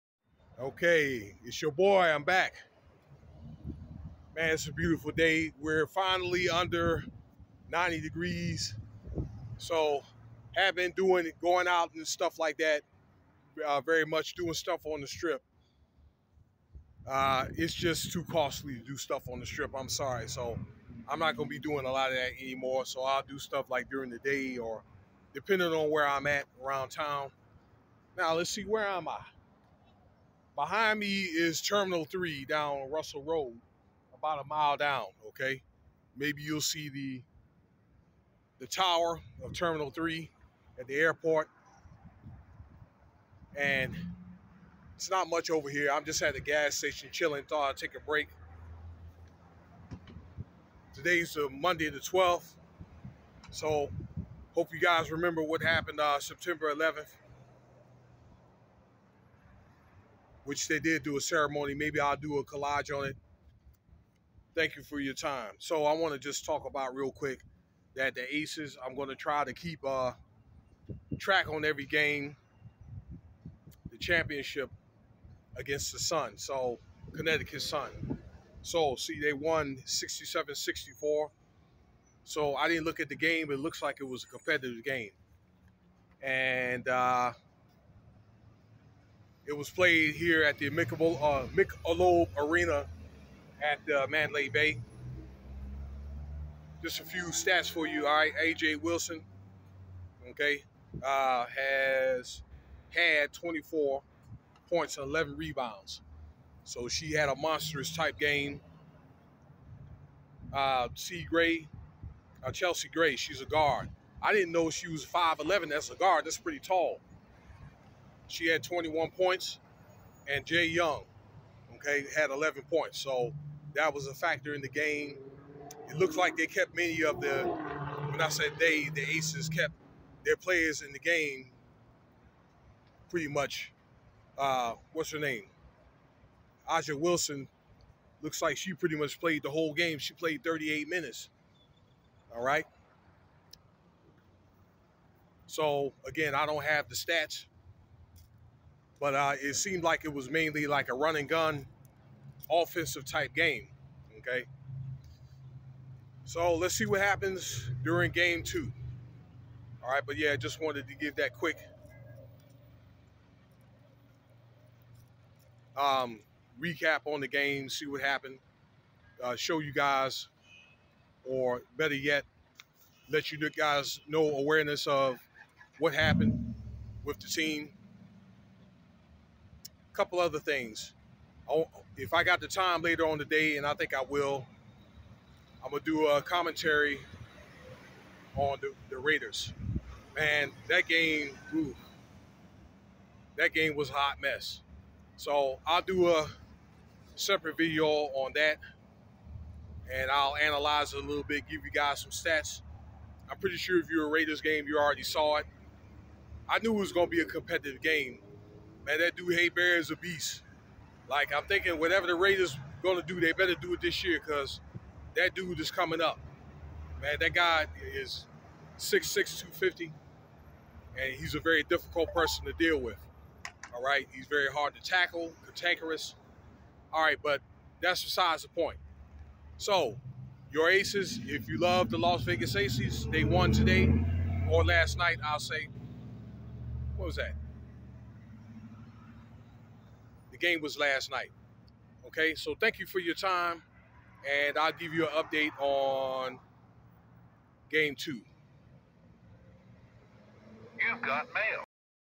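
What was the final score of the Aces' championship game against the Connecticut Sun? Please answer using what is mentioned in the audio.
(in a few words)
67-64.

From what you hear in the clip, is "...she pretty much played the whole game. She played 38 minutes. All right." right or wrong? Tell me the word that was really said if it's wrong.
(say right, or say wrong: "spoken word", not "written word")
right.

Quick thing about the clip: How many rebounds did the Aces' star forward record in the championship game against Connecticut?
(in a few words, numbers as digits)
11.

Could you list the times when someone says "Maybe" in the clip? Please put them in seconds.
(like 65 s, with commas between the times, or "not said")
36 s, 61 s.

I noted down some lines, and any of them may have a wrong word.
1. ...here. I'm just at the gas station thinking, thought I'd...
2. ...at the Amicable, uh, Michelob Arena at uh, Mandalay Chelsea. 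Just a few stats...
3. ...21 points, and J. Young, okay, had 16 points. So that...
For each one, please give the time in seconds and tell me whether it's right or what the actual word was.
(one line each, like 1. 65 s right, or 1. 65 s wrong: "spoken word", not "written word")
1. 45 s wrong: "chilling", not "thinking"
2. 90 s wrong: "Bay", not "Chelsea"
3. 118 s wrong: "11", not "16".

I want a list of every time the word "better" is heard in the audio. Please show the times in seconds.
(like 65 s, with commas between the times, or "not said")
171 s, 213 s.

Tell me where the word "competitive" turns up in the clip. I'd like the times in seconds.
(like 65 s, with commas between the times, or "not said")
84 s, 207 s.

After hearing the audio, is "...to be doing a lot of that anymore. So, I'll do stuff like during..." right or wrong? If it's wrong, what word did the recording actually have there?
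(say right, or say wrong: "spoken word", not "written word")
right.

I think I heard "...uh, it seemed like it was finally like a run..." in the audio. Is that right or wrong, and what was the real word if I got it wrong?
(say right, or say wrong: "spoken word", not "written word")
wrong: "mainly", not "finally".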